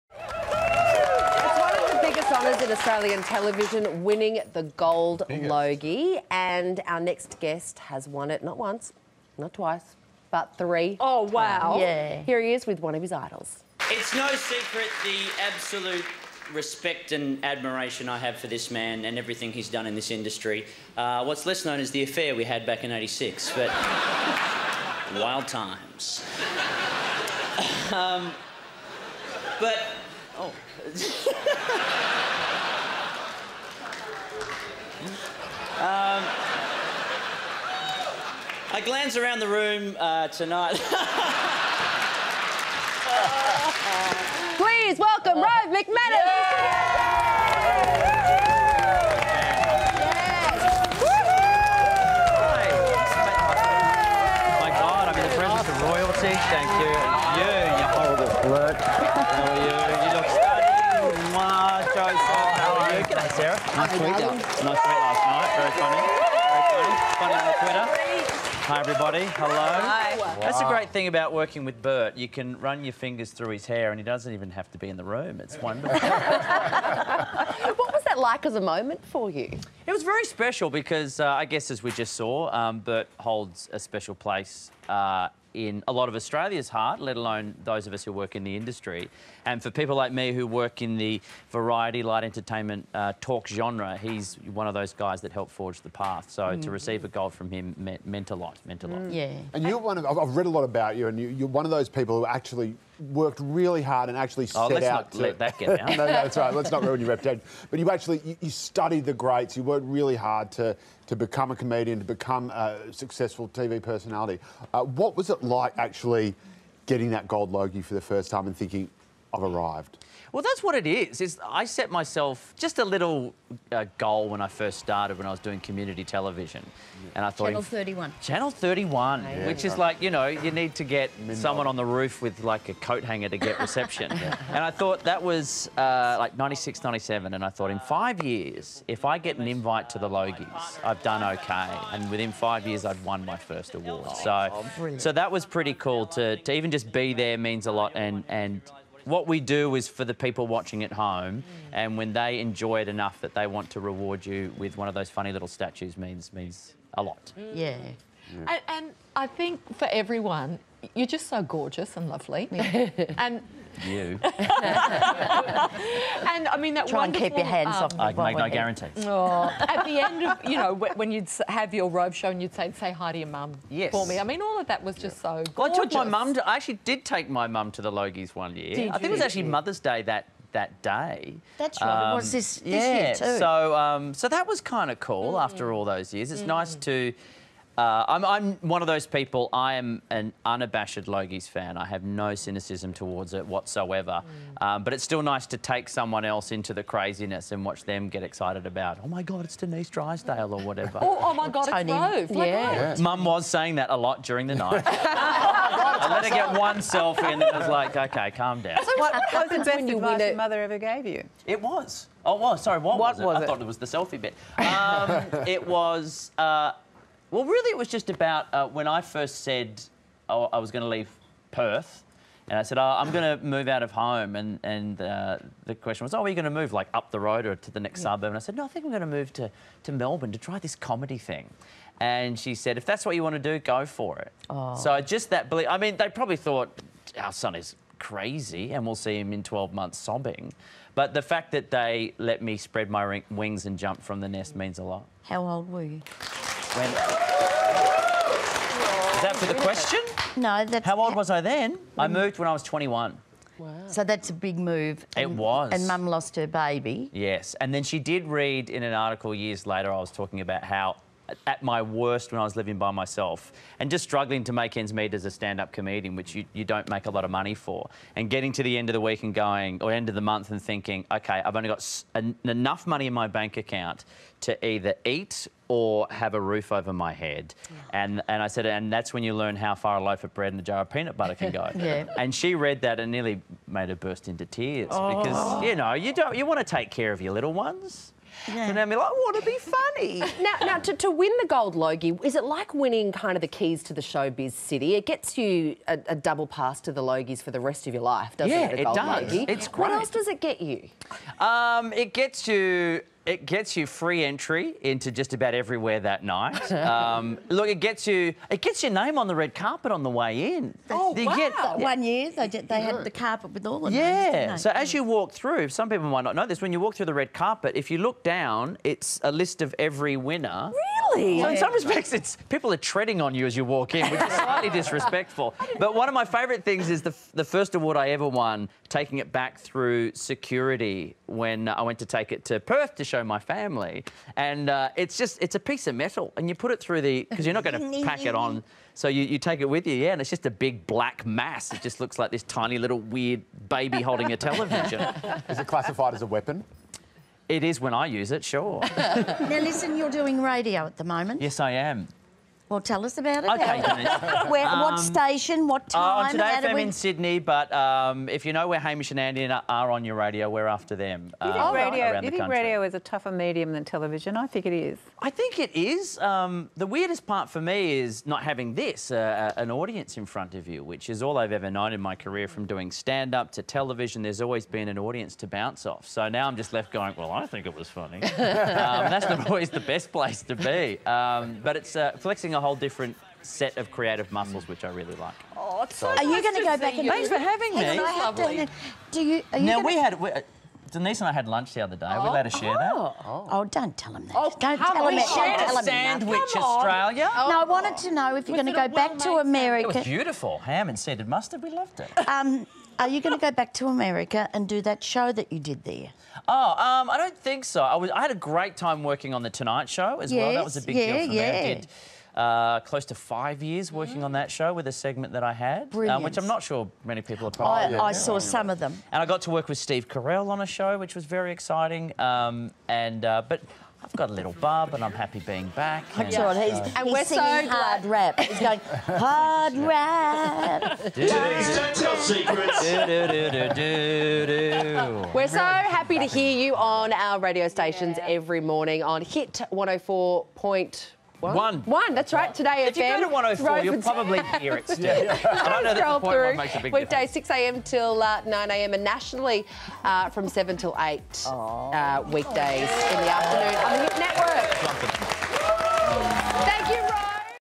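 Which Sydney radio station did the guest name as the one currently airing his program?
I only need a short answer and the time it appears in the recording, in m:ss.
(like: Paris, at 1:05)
Today FM, at 5:56.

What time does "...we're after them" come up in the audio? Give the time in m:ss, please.
6:00.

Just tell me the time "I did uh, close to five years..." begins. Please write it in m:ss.
6:51.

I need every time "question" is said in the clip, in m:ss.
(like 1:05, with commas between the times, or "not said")
3:45, 4:09.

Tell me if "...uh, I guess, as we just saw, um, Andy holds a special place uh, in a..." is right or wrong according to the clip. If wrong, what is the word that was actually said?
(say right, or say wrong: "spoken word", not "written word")
wrong: "Bert", not "Andy".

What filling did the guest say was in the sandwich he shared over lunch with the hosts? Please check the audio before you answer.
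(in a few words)
Ham and seeded mustard.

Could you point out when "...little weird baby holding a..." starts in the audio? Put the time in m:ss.
5:42.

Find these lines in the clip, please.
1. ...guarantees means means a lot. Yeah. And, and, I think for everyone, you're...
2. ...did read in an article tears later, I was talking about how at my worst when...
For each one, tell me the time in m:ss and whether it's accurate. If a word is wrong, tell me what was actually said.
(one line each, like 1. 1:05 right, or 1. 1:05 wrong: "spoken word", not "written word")
1. 2:35 wrong: "statues", not "guarantees"
2. 4:17 wrong: "years", not "tears".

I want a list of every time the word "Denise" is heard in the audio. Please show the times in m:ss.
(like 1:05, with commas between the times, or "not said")
3:19, 6:30.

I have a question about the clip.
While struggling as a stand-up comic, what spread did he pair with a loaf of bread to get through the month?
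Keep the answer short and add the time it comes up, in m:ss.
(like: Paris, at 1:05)
peanut butter, at 4:40.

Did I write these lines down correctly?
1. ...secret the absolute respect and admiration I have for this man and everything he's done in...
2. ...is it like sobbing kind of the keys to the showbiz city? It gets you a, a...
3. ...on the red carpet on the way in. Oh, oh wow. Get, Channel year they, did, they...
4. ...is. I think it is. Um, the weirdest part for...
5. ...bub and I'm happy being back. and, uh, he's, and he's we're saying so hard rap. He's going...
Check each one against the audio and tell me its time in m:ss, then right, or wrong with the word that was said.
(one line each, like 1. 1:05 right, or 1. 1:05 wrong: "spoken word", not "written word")
1. 0:14 right
2. 4:52 wrong: "winning", not "sobbing"
3. 5:09 wrong: "One", not "Channel"
4. 6:04 right
5. 7:04 wrong: "singing", not "saying".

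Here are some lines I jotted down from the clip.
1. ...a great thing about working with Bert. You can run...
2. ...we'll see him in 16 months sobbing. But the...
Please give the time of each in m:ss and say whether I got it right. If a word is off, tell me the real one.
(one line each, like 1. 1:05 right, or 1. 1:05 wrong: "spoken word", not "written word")
1. 1:10 right
2. 3:58 wrong: "12", not "16".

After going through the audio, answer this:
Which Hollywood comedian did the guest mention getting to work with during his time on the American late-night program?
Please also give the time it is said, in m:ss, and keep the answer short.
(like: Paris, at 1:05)
Steve Carell, at 6:59.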